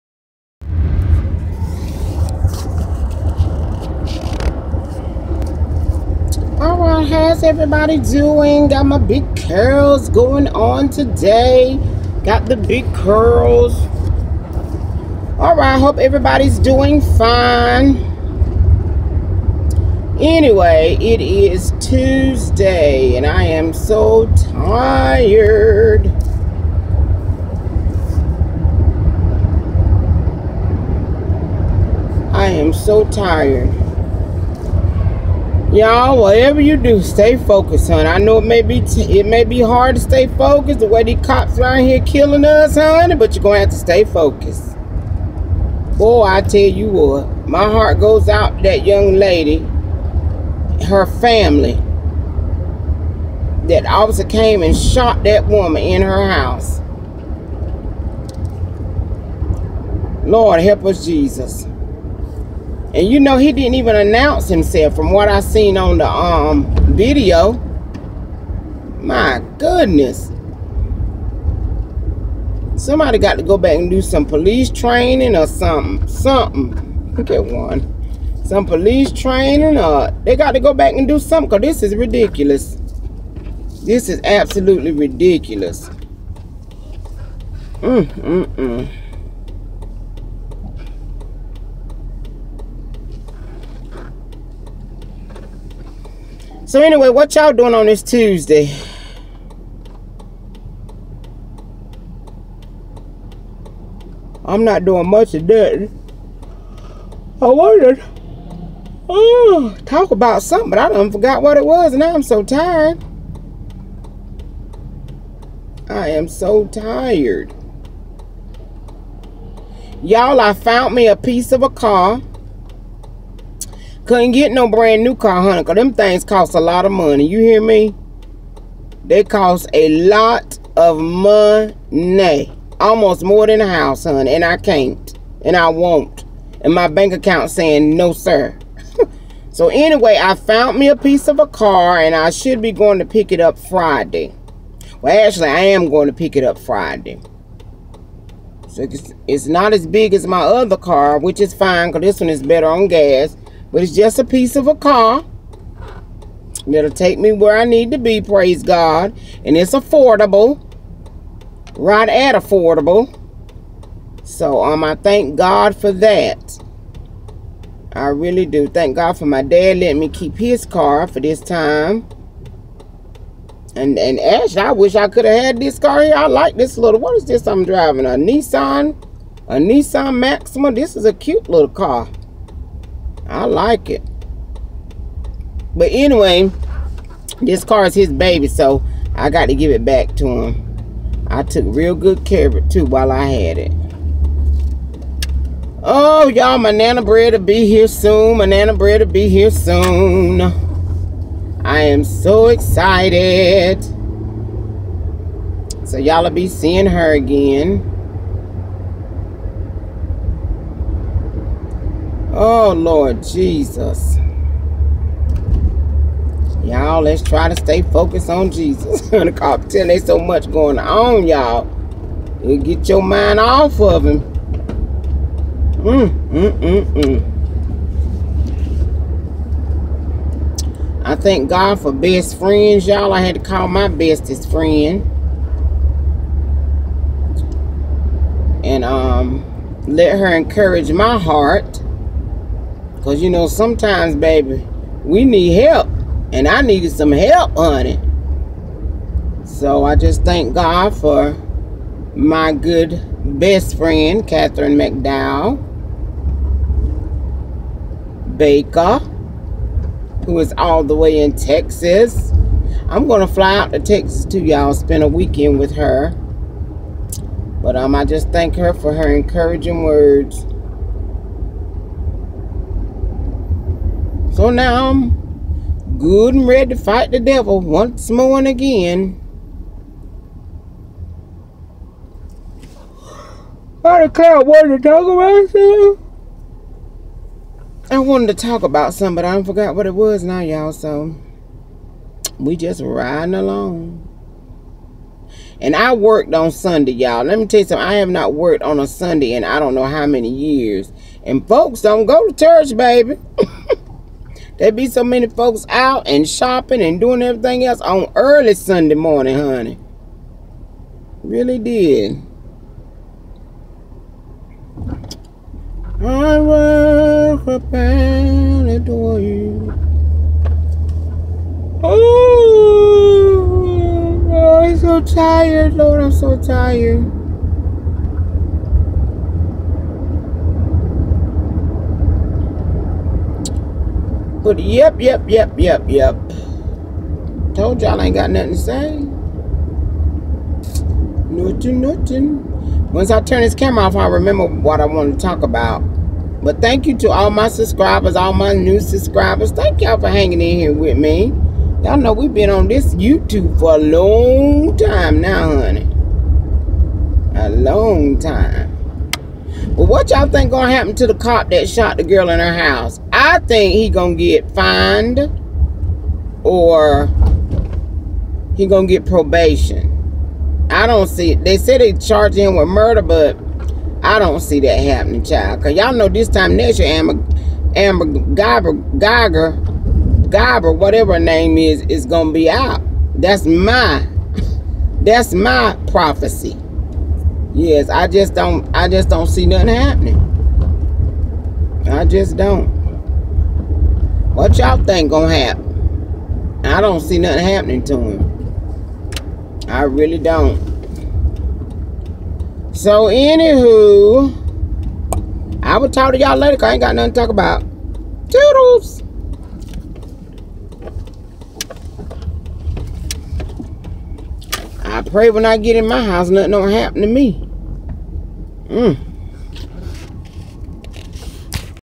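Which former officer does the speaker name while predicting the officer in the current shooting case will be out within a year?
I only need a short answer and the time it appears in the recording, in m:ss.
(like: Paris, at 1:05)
Amber Guyger, at 6:16.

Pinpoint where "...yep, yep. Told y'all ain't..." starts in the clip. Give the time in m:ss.
5:35.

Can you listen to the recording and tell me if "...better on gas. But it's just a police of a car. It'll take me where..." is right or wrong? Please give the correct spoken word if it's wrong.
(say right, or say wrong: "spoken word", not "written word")
wrong: "piece", not "police".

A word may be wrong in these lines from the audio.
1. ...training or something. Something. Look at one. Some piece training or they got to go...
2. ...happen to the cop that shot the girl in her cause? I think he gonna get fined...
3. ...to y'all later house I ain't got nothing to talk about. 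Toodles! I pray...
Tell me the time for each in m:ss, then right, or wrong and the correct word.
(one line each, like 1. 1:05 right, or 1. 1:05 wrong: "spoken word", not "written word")
1. 1:14 wrong: "police", not "piece"
2. 6:00 wrong: "house", not "cause"
3. 6:46 wrong: "cause", not "house".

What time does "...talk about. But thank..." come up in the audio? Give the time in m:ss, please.
5:45.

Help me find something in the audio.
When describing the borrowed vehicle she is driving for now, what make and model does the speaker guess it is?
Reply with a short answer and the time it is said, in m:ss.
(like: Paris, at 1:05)
Nissan Maxima, at 2:59.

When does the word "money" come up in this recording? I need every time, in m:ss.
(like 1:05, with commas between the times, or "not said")
2:06, 2:10.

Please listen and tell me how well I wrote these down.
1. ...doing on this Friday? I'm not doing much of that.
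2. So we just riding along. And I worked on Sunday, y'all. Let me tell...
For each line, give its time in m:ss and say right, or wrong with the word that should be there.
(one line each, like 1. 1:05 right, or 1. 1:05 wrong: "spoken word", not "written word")
1. 1:37 wrong: "Tuesday", not "Friday"
2. 4:50 right.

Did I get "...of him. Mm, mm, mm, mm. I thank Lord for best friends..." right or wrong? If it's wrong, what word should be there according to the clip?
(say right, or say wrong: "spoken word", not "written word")
wrong: "God", not "Lord".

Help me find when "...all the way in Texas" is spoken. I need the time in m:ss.
4:20.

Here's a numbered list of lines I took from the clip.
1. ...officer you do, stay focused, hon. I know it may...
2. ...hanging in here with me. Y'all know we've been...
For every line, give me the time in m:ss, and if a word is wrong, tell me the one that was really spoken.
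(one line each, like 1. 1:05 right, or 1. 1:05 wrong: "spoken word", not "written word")
1. 0:36 wrong: "whatever", not "officer"
2. 5:50 right.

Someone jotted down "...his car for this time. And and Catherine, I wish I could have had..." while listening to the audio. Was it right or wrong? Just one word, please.
wrong.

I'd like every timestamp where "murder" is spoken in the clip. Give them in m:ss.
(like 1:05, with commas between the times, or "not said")
6:12.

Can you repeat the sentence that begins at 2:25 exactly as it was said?
Well, actually, I am going to pick it up Friday.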